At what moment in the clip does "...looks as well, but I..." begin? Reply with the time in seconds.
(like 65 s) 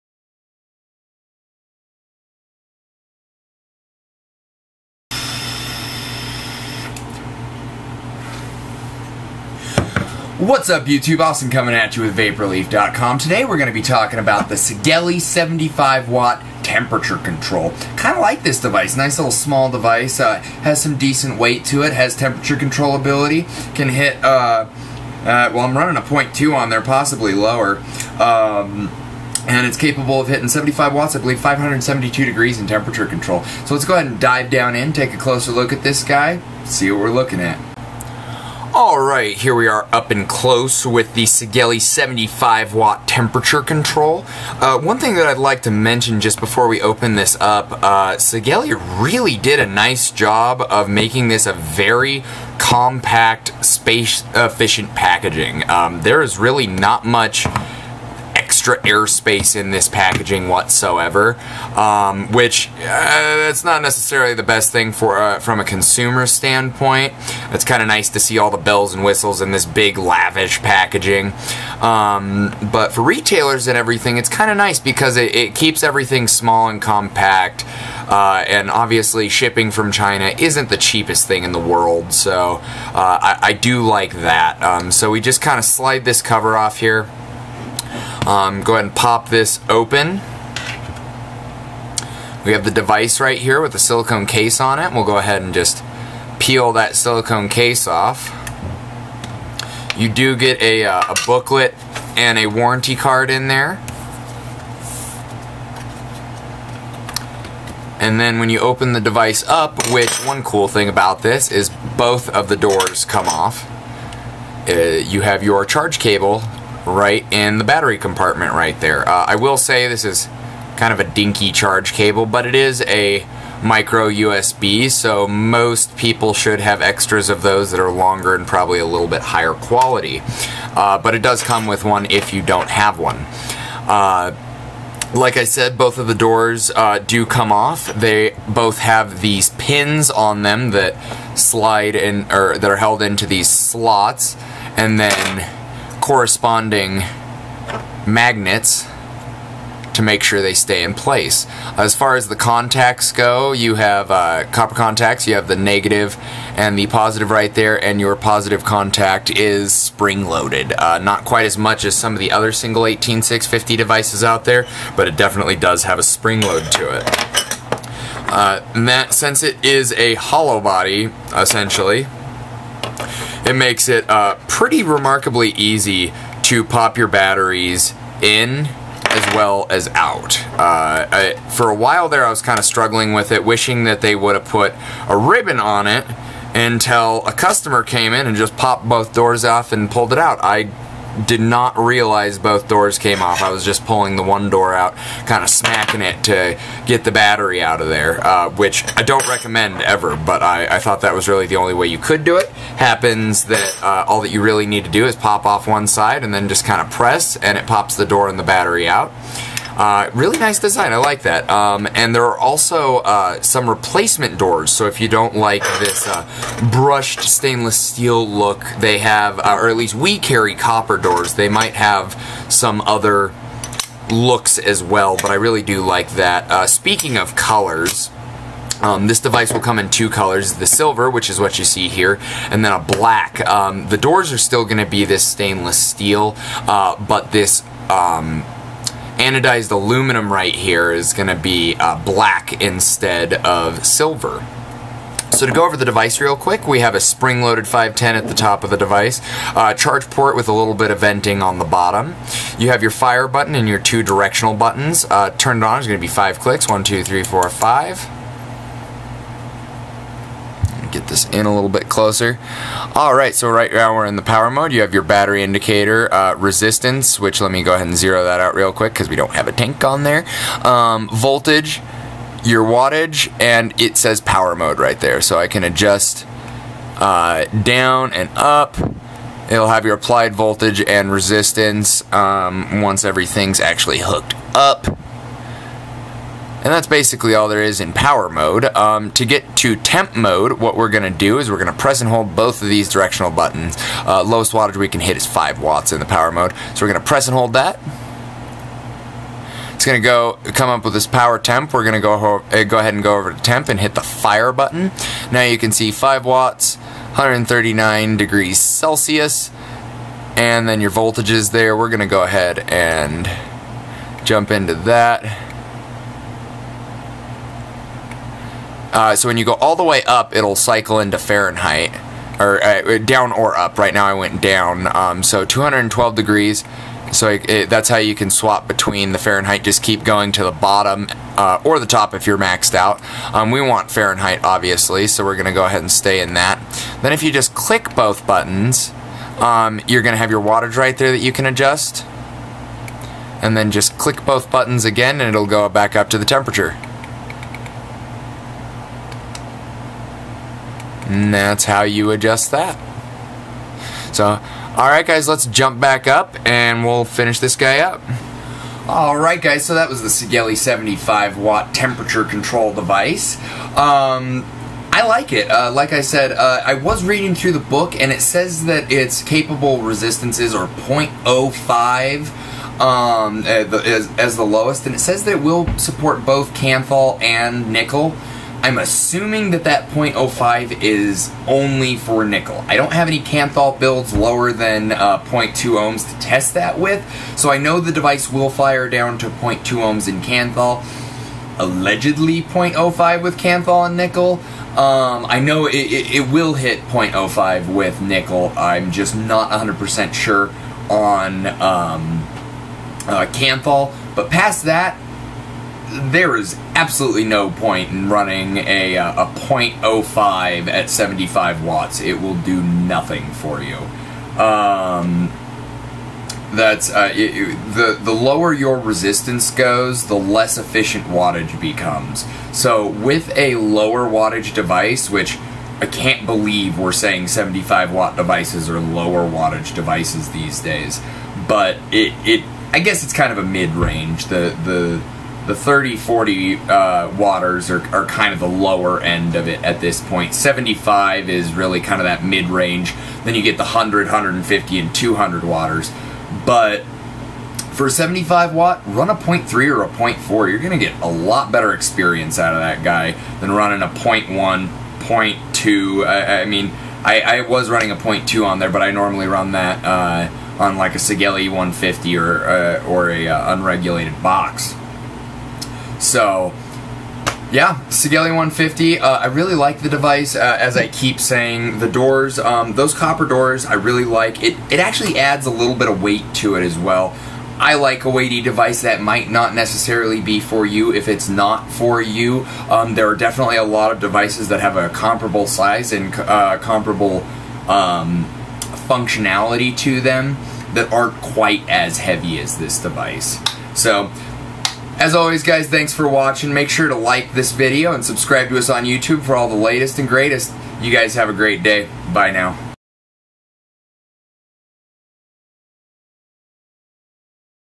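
224 s.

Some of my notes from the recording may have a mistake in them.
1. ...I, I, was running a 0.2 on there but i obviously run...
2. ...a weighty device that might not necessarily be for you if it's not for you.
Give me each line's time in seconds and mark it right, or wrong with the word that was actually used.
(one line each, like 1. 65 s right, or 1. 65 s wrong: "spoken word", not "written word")
1. 457 s wrong: "normally", not "obviously"
2. 478 s right.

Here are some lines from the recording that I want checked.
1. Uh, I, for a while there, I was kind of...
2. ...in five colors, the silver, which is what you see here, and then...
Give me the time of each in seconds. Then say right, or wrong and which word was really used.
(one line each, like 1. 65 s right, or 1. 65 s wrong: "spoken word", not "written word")
1. 180 s right
2. 229 s wrong: "two", not "five".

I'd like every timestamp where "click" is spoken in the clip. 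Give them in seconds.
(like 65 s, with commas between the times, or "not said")
256 s, 337 s, 343 s.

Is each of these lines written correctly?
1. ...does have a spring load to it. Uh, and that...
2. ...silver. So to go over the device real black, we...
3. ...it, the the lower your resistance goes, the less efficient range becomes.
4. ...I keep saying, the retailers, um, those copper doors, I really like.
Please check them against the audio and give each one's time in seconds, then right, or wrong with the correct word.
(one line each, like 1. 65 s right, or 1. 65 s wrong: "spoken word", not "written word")
1. 165 s right
2. 243 s wrong: "quick", not "black"
3. 417 s wrong: "wattage", not "range"
4. 470 s wrong: "doors", not "retailers".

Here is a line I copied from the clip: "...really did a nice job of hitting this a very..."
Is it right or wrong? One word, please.
wrong.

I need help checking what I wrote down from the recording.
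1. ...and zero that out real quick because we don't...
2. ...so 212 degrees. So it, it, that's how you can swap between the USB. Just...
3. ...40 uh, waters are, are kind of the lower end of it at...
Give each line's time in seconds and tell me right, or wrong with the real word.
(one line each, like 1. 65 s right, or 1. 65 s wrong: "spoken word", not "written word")
1. 267 s right
2. 325 s wrong: "Fahrenheit", not "USB"
3. 435 s right.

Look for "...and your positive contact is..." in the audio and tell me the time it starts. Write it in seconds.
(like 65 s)
157 s.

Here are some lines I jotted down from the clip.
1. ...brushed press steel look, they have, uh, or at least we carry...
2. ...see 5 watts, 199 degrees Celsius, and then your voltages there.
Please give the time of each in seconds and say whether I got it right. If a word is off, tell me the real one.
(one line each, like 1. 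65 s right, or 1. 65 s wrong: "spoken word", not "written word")
1. 216 s wrong: "stainless", not "press"
2. 305 s wrong: "139", not "199".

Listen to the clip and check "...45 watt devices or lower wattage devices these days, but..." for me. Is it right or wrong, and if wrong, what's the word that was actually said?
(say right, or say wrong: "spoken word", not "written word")
wrong: "75", not "45".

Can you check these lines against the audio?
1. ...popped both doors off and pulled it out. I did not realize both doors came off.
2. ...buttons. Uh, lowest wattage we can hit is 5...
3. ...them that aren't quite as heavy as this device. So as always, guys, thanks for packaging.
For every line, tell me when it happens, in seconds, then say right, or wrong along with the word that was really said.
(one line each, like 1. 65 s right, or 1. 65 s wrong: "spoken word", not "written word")
1. 188 s right
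2. 293 s right
3. 490 s wrong: "watching", not "packaging".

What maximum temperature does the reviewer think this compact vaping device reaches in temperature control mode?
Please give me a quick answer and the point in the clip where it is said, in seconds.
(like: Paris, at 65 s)
572 degrees, at 31 s.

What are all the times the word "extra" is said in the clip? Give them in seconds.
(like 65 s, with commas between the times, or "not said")
58 s, 126 s.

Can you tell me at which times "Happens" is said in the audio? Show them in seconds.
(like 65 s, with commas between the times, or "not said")
202 s.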